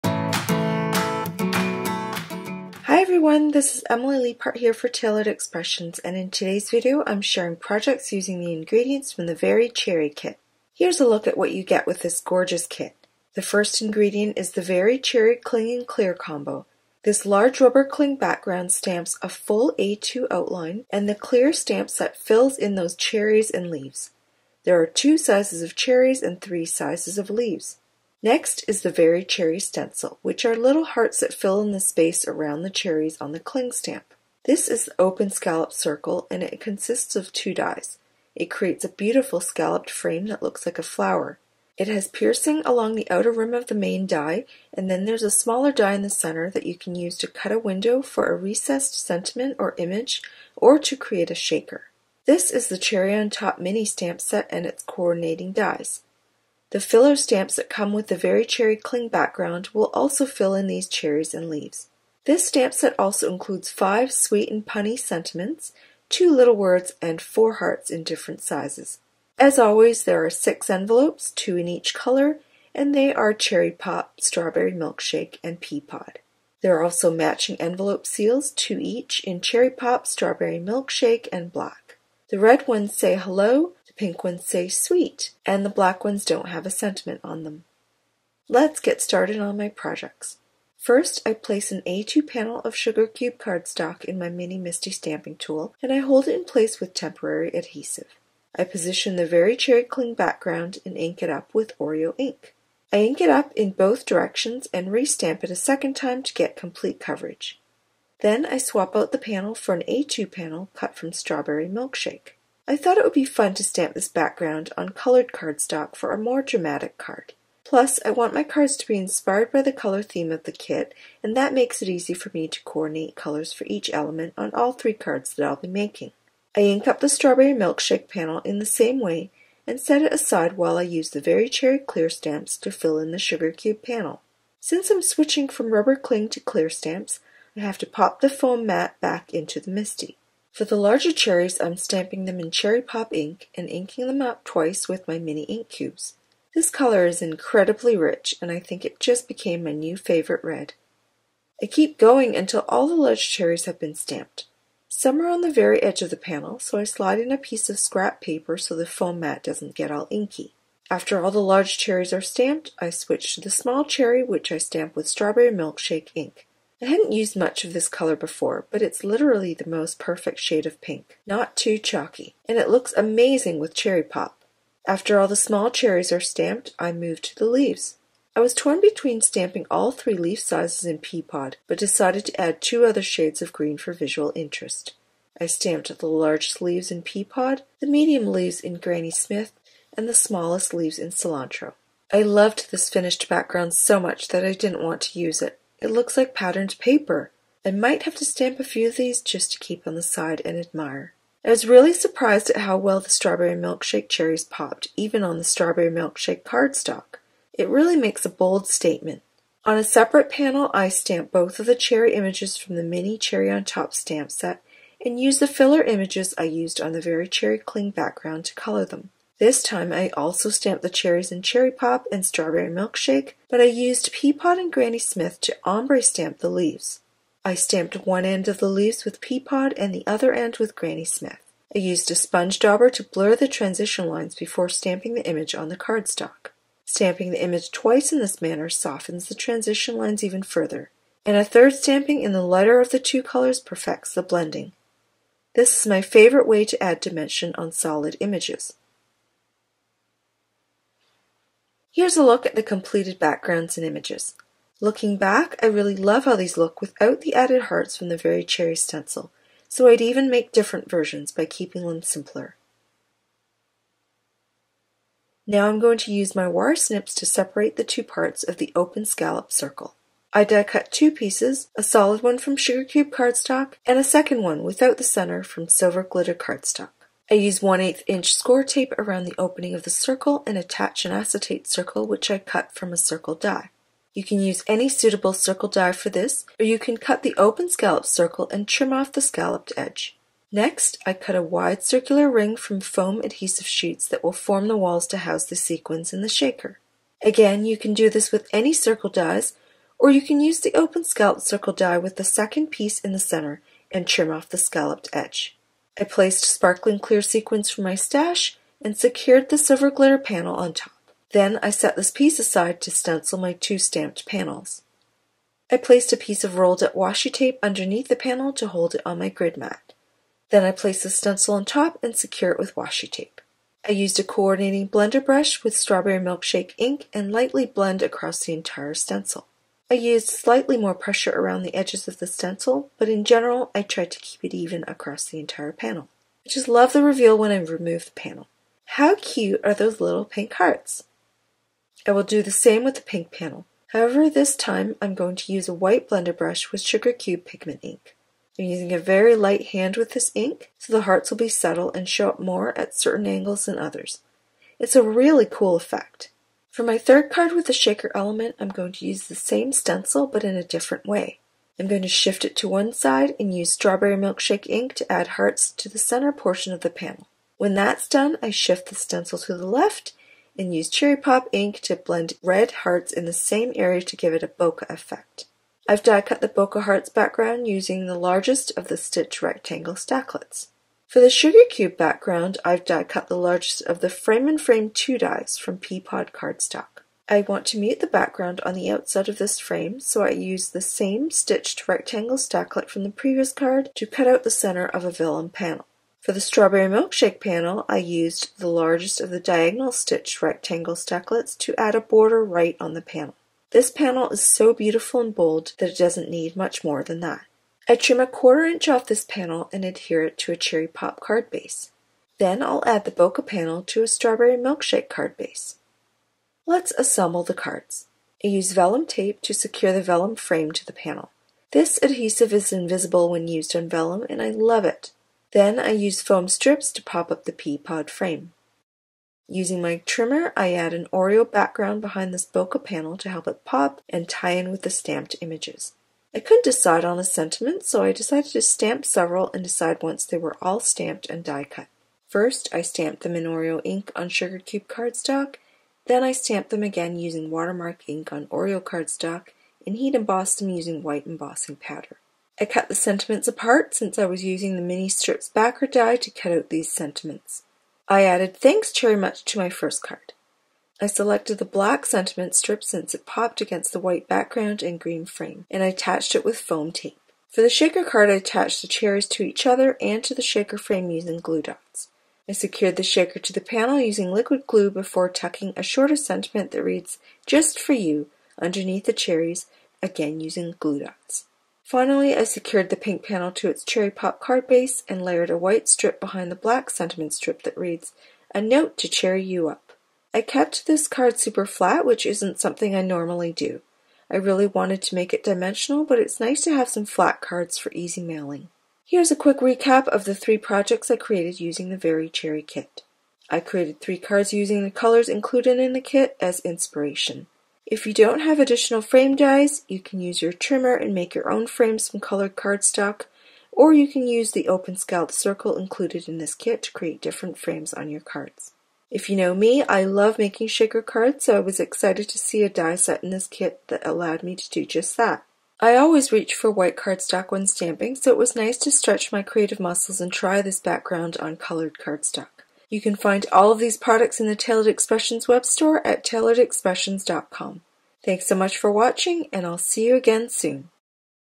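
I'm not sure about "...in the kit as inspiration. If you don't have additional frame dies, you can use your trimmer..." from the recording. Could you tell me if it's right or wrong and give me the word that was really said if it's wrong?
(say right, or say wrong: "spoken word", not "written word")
right.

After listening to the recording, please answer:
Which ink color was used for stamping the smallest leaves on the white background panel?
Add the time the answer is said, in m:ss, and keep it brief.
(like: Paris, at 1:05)
Cilantro, at 3:11.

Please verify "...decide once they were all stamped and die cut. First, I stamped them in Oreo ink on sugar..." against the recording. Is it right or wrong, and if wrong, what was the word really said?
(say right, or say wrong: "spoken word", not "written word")
right.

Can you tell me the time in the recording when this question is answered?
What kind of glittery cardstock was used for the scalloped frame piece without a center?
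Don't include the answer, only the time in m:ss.
4:35.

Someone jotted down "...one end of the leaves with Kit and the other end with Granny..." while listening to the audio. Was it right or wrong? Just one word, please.
wrong.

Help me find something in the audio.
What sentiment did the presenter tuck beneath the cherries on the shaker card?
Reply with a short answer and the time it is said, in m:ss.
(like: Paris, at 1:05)
Just for you, at 7:57.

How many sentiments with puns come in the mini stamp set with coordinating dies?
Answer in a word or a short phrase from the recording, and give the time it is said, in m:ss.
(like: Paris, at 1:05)
5, at 1:03.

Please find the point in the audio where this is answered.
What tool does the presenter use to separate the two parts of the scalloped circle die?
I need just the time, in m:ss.
4:26.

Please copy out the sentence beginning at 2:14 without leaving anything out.
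Since I'm switching from rubber cling to clear stamps, I have to pop the foam mat back into the MISTI.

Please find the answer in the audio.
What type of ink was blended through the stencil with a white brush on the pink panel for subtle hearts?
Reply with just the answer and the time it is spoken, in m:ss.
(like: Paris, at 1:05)
Sugar Cube Pigment ink, at 5:46.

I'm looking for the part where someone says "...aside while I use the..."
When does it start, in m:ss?
2:10.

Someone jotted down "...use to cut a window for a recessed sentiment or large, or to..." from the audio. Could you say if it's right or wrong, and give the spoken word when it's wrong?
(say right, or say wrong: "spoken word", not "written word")
wrong: "image", not "large".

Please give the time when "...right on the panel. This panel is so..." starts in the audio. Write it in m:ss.
6:42.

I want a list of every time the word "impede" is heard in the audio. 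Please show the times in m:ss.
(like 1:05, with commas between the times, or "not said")
not said.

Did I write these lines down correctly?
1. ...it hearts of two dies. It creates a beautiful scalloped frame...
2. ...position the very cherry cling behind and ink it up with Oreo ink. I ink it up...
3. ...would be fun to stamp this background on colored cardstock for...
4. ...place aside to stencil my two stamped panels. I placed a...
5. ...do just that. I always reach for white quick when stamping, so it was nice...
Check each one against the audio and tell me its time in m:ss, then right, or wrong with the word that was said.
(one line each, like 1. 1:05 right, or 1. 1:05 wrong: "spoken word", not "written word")
1. 0:36 wrong: "consists", not "hearts"
2. 1:38 wrong: "background", not "behind"
3. 1:53 right
4. 5:12 wrong: "piece", not "place"
5. 8:44 wrong: "cardstock", not "quick".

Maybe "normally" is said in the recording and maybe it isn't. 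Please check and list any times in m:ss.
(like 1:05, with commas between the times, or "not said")
8:13.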